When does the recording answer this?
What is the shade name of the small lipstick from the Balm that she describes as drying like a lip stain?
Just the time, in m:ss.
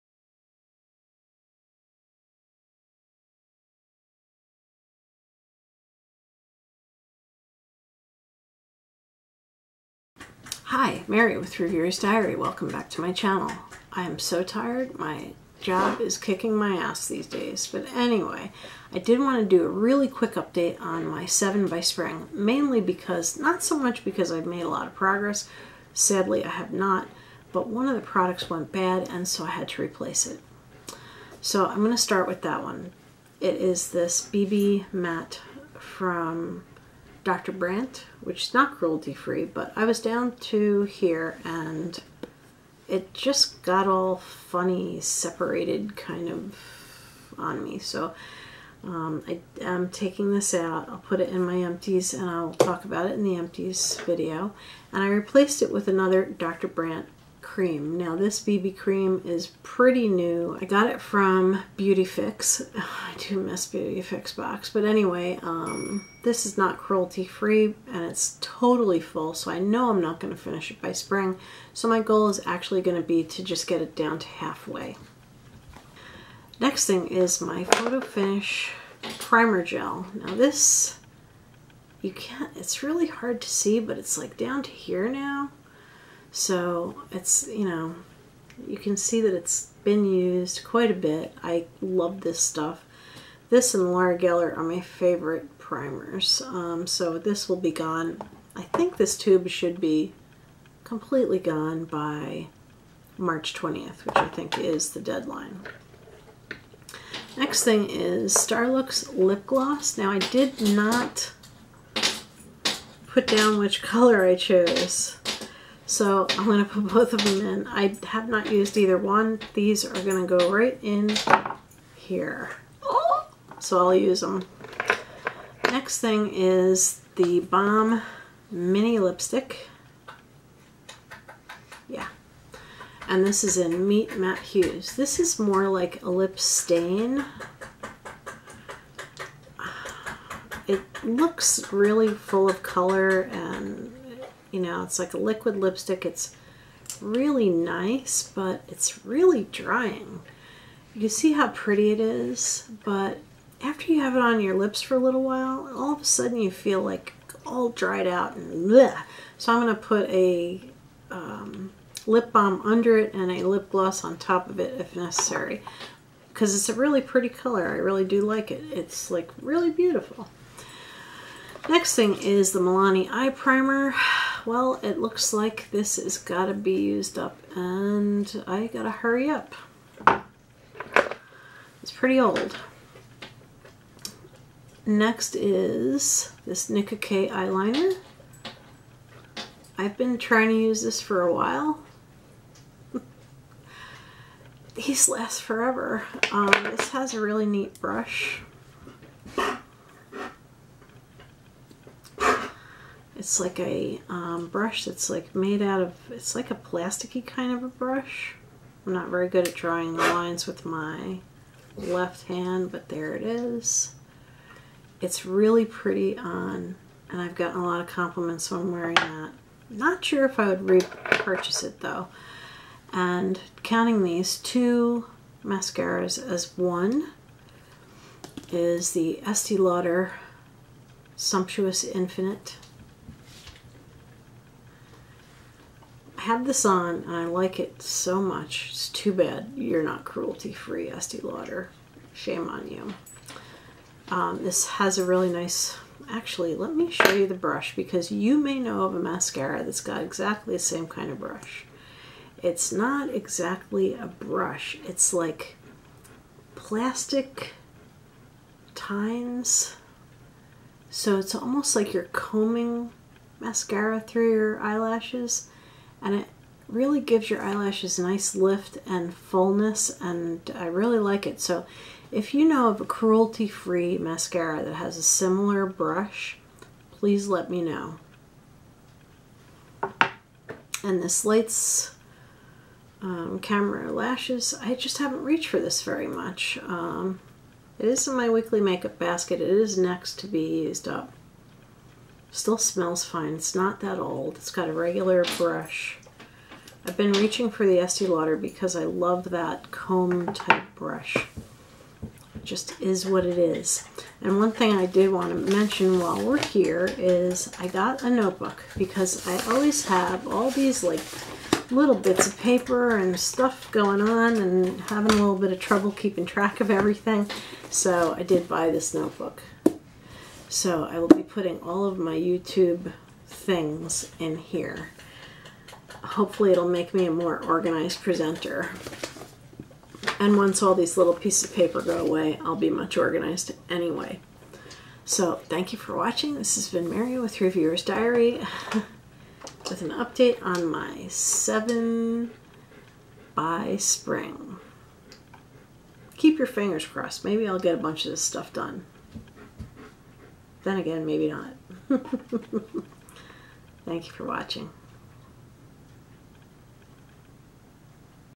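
2:13.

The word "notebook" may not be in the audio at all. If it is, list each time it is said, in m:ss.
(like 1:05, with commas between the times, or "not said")
5:08, 5:18.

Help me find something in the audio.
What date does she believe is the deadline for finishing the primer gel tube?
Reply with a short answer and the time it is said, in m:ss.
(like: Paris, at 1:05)
March 20th, at 1:43.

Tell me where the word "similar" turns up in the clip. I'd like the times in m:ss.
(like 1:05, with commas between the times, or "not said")
4:35.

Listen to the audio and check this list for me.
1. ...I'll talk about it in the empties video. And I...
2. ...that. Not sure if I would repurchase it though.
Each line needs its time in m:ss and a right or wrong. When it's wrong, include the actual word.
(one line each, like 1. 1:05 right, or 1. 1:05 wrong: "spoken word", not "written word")
1. 0:52 right
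2. 3:38 right.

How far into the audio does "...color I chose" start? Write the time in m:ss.
1:53.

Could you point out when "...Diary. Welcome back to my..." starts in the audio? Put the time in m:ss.
0:11.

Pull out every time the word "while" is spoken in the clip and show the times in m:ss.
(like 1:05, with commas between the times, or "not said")
2:35, 3:11, 5:05.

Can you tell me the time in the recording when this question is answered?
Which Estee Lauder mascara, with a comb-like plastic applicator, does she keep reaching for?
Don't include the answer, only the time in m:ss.
3:51.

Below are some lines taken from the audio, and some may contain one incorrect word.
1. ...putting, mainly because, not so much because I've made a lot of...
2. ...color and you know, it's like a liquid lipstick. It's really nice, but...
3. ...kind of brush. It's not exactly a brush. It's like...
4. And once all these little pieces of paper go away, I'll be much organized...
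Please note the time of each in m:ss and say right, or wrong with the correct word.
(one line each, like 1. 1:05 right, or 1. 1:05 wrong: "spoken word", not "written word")
1. 0:21 wrong: "spring", not "putting"
2. 2:22 right
3. 4:10 right
4. 5:30 right.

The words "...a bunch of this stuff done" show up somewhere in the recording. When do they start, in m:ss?
5:47.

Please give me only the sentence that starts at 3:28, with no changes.
I'm not very good at drawing the lines with my left hand, but there it is.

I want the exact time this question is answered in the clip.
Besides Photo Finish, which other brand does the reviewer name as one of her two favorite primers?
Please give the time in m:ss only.
1:33.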